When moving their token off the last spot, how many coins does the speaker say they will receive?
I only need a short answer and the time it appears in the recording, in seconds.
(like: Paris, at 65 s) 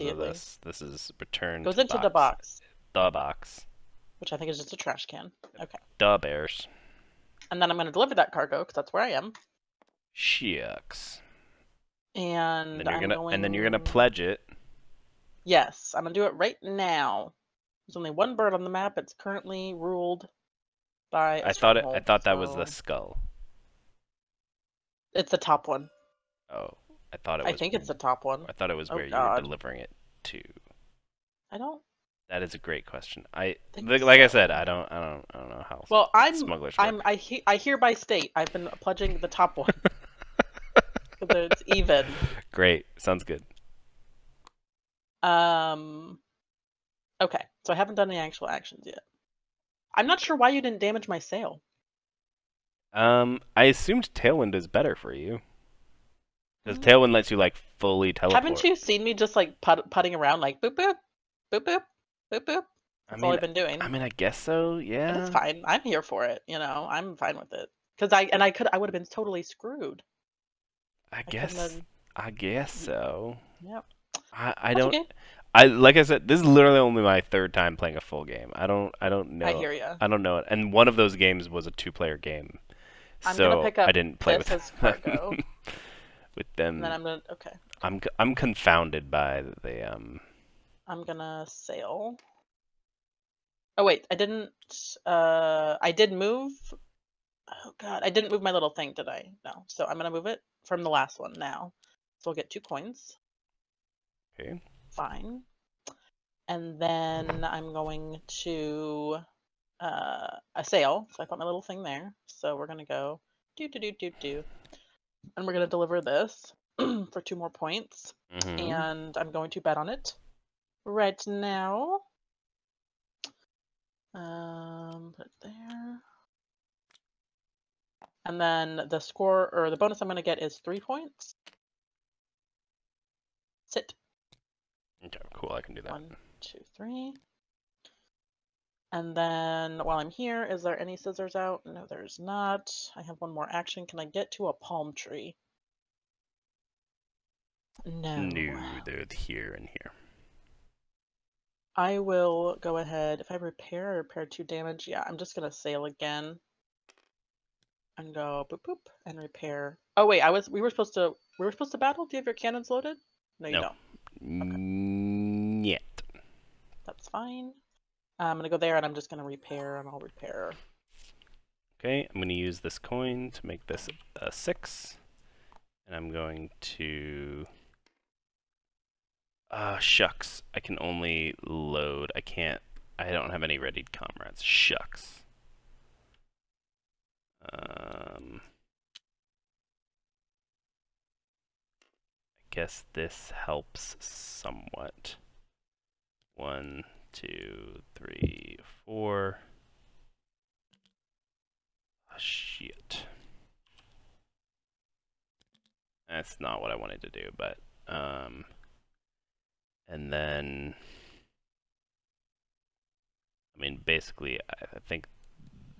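2, at 102 s.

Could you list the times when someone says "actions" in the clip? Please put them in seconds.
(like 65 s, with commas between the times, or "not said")
48 s, 143 s.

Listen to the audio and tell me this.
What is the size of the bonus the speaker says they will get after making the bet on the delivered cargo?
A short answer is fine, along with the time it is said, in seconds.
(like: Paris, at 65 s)
3 points, at 130 s.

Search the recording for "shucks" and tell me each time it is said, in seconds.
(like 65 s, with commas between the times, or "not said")
10 s, 179 s, 184 s.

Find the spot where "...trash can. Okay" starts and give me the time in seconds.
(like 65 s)
4 s.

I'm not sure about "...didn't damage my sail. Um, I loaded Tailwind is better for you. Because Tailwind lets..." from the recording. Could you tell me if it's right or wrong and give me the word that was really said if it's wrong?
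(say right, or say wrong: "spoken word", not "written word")
wrong: "assumed", not "loaded".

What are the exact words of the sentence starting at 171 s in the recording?
Okay, I'm going to use this coin to make this a 6.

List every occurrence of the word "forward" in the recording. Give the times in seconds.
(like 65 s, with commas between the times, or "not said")
not said.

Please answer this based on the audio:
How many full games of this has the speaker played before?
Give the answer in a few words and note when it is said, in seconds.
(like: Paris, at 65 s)
3, at 77 s.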